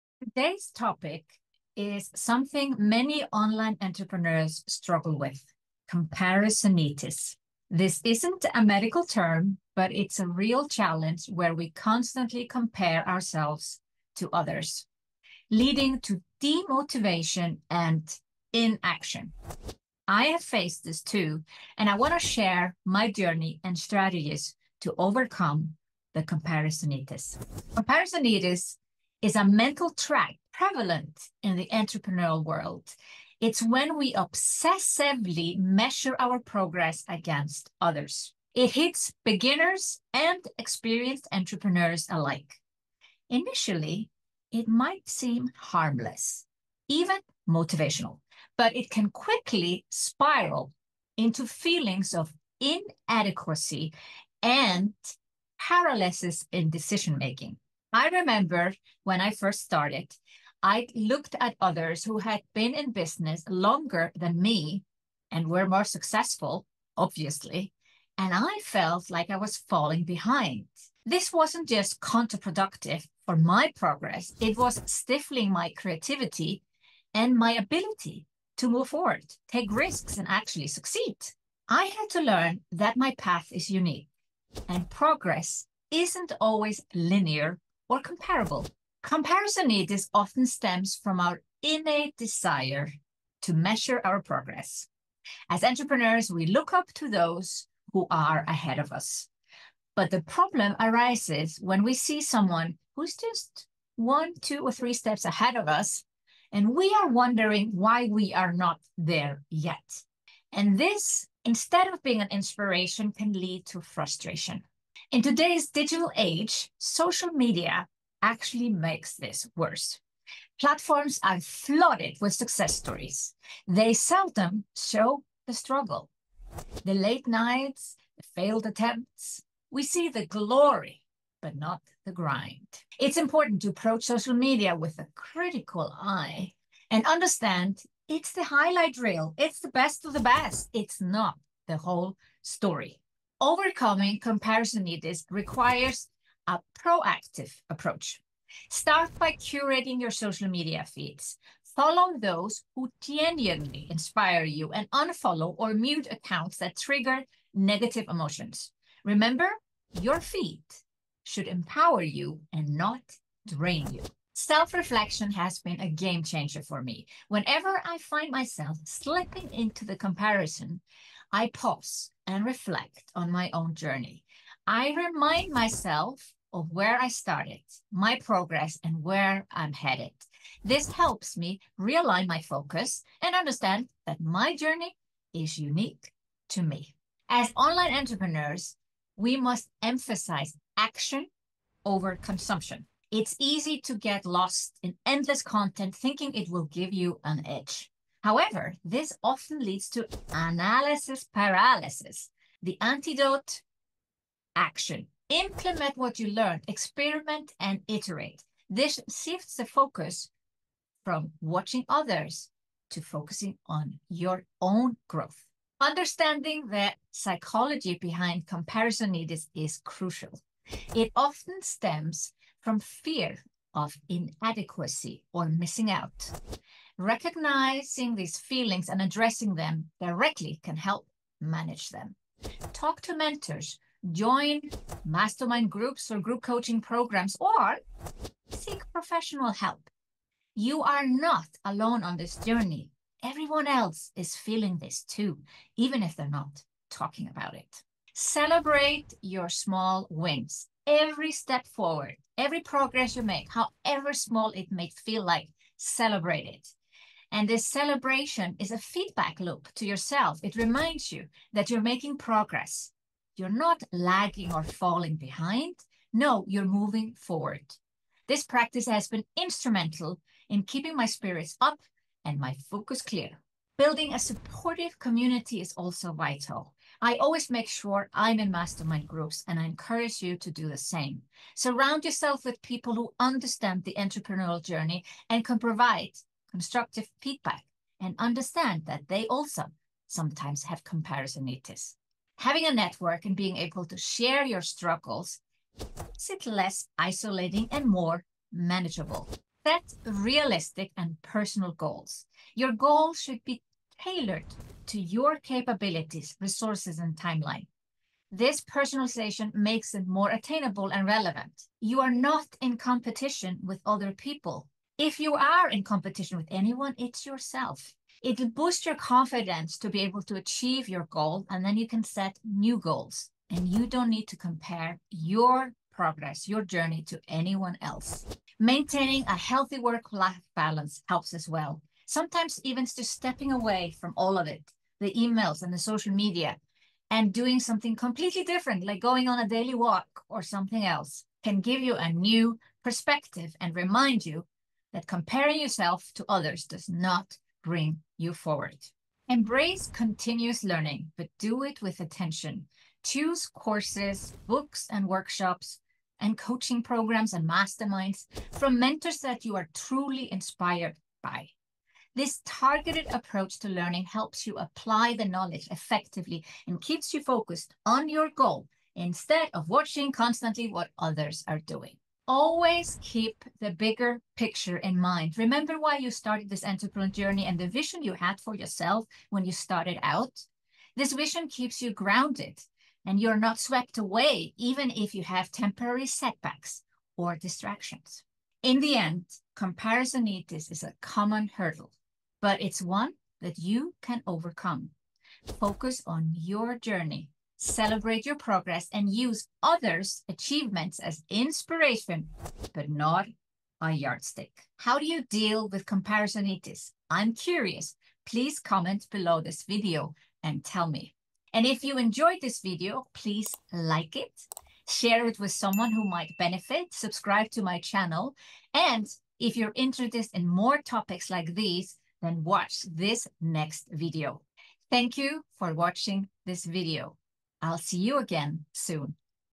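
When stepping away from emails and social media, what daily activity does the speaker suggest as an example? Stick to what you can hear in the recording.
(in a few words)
A daily walk.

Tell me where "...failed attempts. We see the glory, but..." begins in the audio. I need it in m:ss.
2:08.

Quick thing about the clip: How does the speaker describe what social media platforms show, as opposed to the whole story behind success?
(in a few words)
The highlight reel.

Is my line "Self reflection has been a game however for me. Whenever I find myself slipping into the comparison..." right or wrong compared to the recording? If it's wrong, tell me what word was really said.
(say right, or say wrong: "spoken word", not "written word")
wrong: "changer", not "however".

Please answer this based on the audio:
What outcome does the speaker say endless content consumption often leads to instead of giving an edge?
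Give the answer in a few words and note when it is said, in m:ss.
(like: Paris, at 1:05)
Analysis paralysis, at 3:20.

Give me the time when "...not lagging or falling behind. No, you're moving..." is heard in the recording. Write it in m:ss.
4:23.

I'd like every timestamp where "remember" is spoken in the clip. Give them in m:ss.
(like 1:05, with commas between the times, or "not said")
0:58, 2:39, 6:15.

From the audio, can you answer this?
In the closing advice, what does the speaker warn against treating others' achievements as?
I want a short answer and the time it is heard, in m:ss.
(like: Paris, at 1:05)
A yardstick, at 6:43.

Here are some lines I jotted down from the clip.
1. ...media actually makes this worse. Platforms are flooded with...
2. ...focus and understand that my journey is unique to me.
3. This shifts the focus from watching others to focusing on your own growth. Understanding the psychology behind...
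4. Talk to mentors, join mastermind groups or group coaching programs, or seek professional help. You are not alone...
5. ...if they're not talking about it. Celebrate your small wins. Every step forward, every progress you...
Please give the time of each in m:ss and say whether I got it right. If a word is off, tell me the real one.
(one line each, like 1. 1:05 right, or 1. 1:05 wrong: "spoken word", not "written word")
1. 1:57 right
2. 3:02 right
3. 3:28 right
4. 3:52 right
5. 4:06 right.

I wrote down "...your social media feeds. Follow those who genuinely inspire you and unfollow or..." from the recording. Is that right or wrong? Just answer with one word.
right.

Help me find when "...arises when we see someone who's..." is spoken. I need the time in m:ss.
1:40.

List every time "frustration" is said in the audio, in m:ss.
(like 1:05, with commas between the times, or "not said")
1:53.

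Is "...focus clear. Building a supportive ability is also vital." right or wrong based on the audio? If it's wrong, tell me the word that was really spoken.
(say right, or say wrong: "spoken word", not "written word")
wrong: "community", not "ability".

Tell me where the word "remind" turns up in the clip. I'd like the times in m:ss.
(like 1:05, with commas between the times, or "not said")
2:54, 4:20, 5:43.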